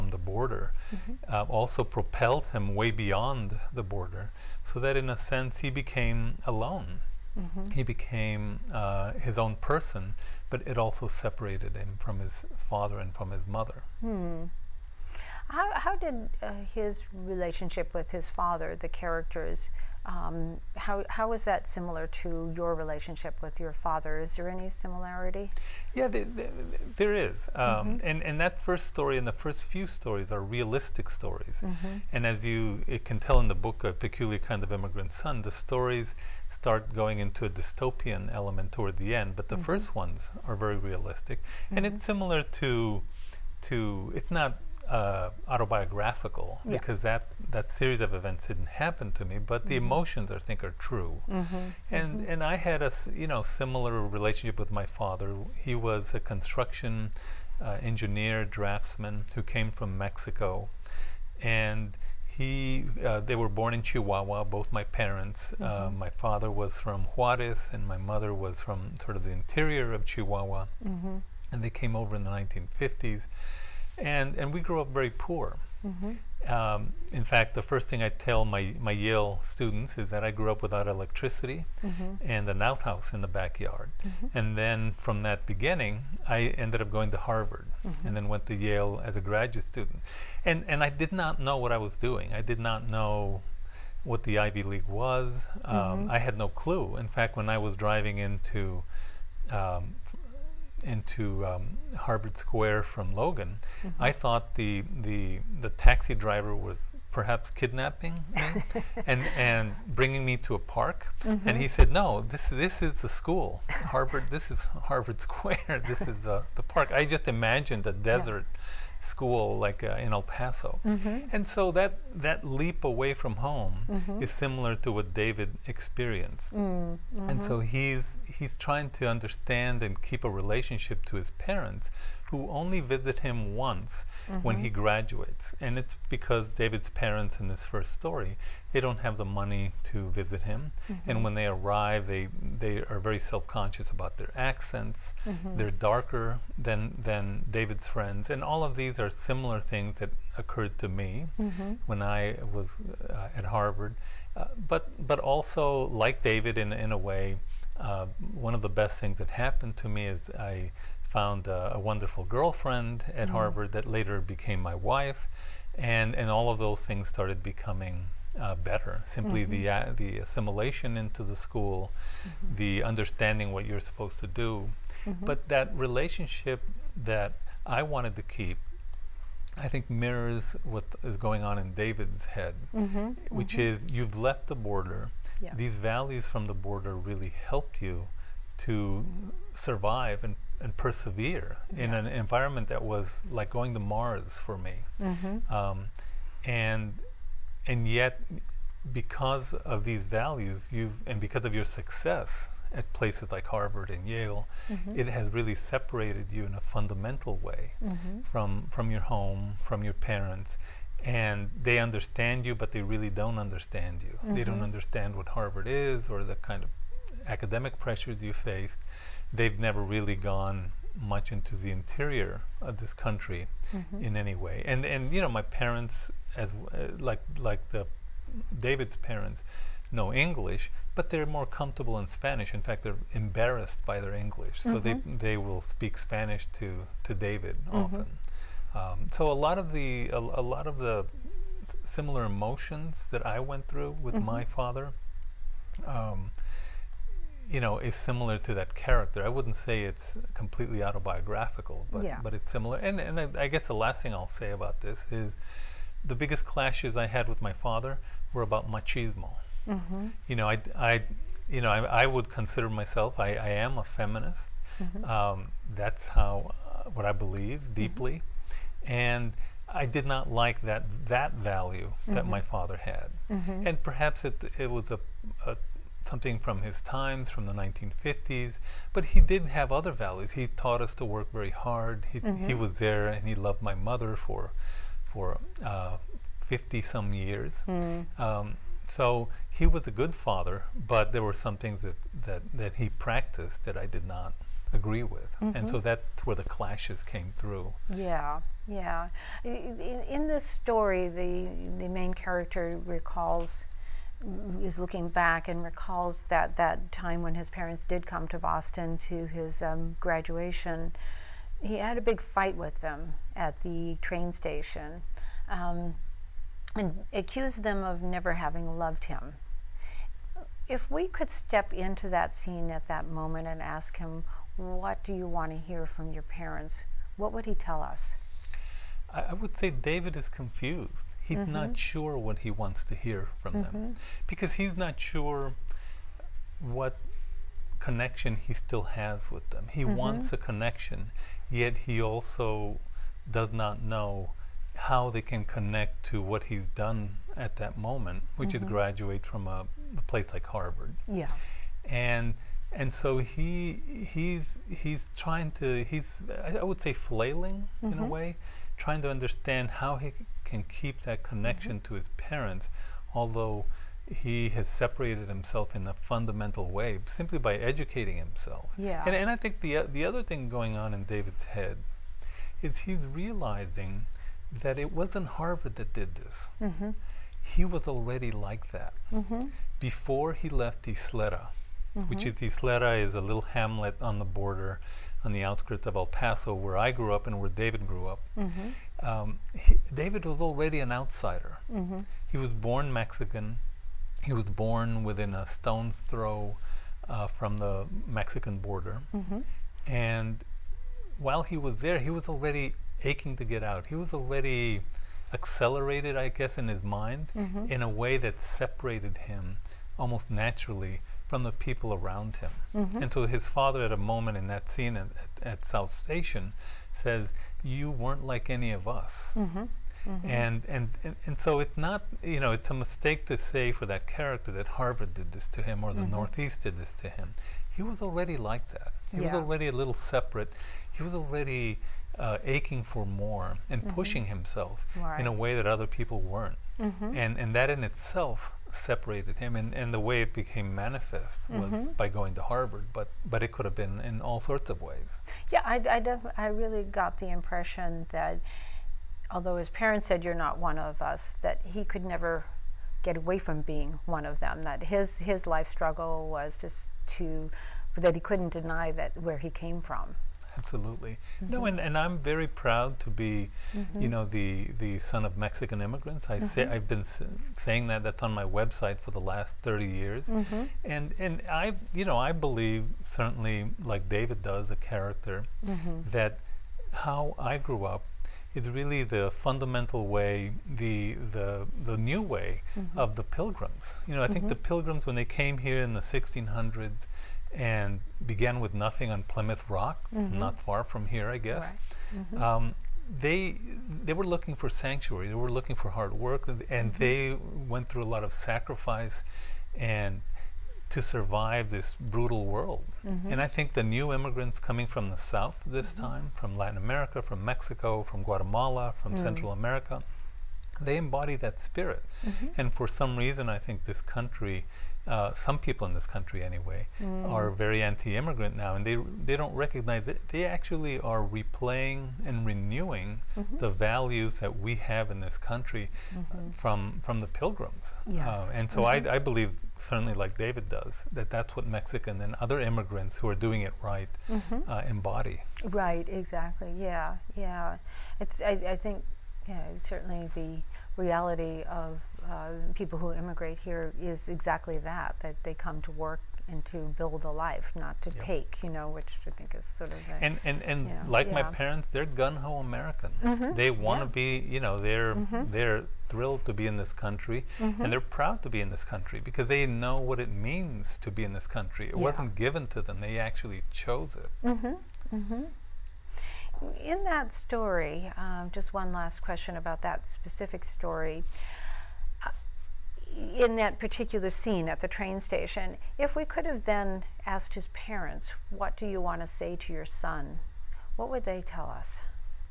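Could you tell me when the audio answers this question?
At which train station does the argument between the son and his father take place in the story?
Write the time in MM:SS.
06:55.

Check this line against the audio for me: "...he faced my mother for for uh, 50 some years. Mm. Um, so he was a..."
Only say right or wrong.
wrong.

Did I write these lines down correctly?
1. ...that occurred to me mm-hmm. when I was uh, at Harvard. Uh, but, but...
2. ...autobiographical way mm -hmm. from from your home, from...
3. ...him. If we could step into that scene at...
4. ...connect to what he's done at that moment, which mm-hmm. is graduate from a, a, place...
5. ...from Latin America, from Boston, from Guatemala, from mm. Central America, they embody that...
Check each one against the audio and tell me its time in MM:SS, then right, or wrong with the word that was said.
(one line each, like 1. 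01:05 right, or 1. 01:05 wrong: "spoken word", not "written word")
1. 02:29 right
2. 03:26 wrong: "fundamental", not "autobiographical"
3. 05:19 right
4. 05:45 right
5. 08:26 wrong: "Mexico", not "Boston".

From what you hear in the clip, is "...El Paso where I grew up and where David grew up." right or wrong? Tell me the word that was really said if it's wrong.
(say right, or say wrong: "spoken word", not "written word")
right.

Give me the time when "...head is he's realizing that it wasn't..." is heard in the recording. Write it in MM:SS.
06:11.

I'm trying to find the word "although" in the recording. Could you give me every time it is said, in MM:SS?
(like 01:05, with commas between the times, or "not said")
06:03, 07:29.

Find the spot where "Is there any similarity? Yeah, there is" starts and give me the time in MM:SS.
00:24.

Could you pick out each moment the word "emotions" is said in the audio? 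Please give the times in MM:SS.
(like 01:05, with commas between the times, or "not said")
00:49, 04:02.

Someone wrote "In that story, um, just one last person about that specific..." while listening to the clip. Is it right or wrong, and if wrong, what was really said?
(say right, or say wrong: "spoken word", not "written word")
wrong: "question", not "person".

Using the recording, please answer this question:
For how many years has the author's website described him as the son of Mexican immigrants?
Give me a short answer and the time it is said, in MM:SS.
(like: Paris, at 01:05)
30, at 07:49.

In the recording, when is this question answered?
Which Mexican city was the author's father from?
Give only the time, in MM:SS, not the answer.
01:07.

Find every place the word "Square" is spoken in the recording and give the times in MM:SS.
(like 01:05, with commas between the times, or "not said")
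01:42, 01:55.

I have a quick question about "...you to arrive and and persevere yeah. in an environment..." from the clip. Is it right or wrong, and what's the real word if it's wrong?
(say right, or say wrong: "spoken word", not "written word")
wrong: "survive", not "arrive".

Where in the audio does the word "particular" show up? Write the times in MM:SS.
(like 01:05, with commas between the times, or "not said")
09:33.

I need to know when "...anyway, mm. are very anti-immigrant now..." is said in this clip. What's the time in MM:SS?
08:36.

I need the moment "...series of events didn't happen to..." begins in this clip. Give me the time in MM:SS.
00:47.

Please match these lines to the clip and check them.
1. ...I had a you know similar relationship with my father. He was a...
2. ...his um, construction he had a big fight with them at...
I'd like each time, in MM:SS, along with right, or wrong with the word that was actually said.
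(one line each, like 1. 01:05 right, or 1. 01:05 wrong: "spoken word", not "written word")
1. 00:52 right
2. 05:09 wrong: "graduation", not "construction".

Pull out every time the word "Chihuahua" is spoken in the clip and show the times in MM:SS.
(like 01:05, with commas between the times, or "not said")
01:03, 01:10.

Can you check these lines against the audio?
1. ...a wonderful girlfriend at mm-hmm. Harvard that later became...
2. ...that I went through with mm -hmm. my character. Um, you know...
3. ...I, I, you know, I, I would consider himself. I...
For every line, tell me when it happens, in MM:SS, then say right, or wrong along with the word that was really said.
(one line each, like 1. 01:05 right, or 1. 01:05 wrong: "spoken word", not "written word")
1. 02:41 right
2. 04:03 wrong: "father", not "character"
3. 04:20 wrong: "myself", not "himself".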